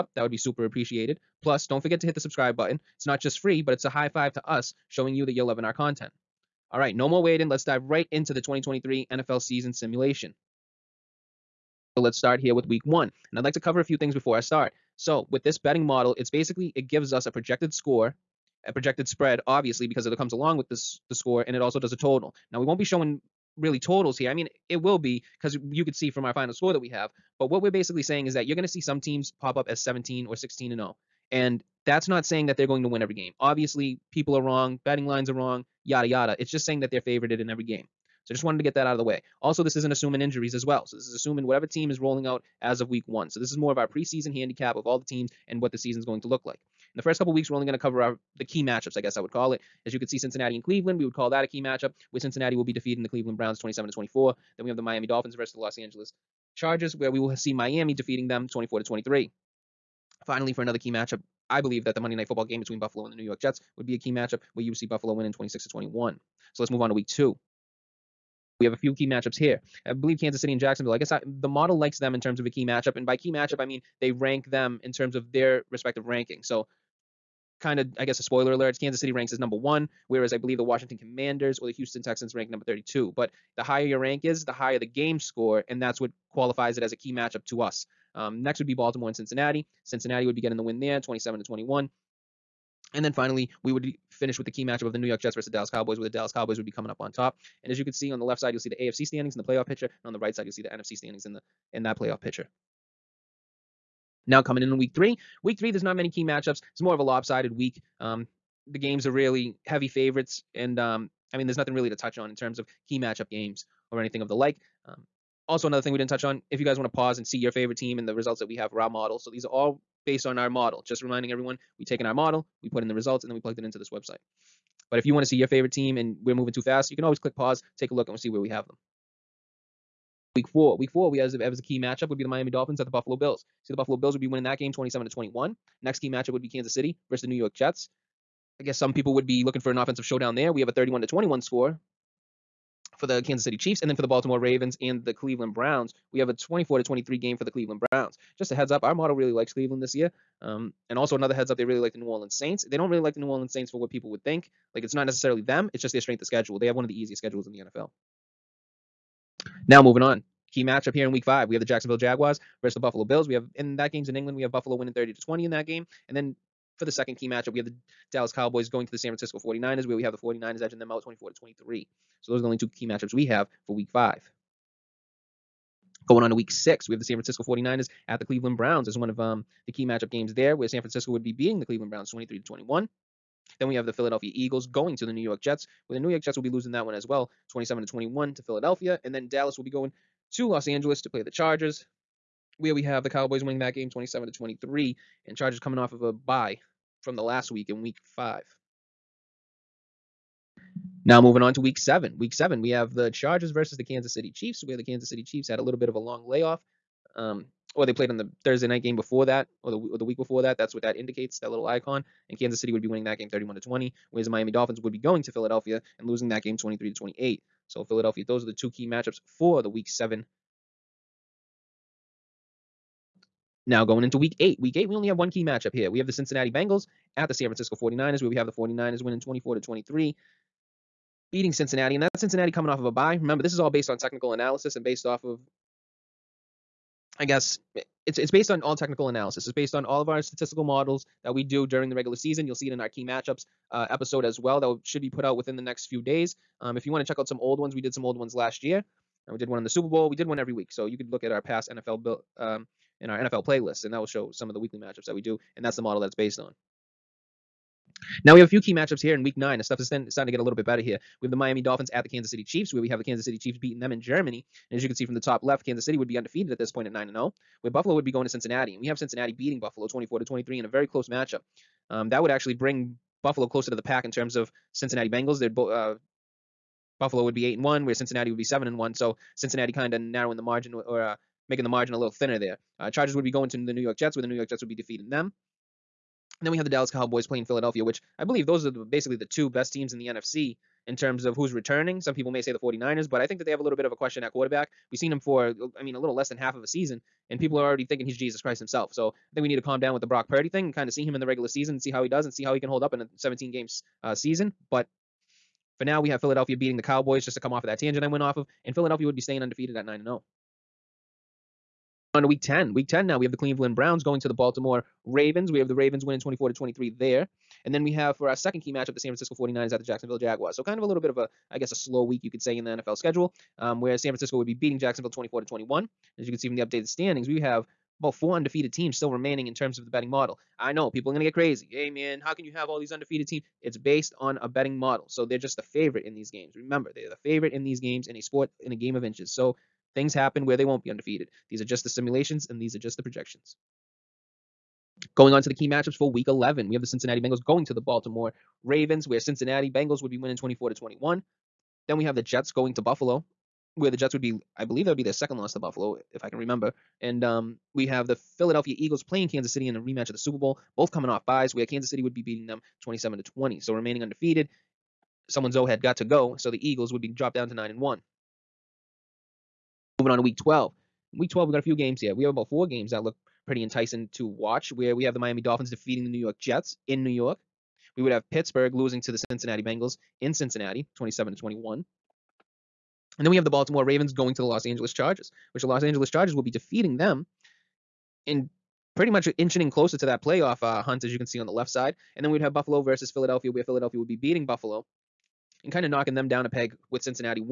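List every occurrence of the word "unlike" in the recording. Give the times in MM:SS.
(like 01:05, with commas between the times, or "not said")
not said.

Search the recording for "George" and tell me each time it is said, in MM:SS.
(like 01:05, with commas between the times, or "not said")
not said.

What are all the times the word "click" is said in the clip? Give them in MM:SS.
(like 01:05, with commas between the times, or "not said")
02:07.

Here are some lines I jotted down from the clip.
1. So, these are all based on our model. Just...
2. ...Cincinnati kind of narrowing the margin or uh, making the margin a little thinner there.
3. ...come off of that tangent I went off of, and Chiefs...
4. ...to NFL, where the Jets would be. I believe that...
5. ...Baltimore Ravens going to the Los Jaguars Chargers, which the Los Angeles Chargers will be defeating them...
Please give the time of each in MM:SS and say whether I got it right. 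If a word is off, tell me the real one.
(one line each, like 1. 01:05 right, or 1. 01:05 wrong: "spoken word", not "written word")
1. 01:59 right
2. 04:39 right
3. 05:07 wrong: "Philadelphia", not "Chiefs"
4. 05:52 wrong: "Buffalo", not "NFL"
5. 06:23 wrong: "Angeles", not "Jaguars".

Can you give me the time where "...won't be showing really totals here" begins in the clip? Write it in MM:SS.
00:22.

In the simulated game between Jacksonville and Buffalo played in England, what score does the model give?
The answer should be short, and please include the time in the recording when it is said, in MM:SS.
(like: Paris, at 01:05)
30-20, at 02:44.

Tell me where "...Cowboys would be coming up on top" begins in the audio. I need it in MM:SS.
01:36.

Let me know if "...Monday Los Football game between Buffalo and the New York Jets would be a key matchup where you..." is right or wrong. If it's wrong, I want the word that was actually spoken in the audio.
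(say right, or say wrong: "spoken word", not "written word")
wrong: "Night", not "Los".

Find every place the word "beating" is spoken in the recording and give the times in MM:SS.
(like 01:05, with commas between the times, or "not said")
03:01, 03:51, 04:23, 04:29, 05:06, 05:24, 06:02, 06:34.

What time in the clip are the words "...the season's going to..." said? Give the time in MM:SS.
00:45.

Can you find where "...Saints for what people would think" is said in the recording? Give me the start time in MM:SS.
02:33.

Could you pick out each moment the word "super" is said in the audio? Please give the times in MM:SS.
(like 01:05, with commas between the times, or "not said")
00:00, 04:09, 06:00.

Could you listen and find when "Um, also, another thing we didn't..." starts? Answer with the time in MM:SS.
01:54.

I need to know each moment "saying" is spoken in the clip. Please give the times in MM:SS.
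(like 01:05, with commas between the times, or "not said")
00:28, 00:32, 00:36.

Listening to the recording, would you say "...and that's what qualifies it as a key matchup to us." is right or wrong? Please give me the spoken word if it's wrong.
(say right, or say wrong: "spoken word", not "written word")
right.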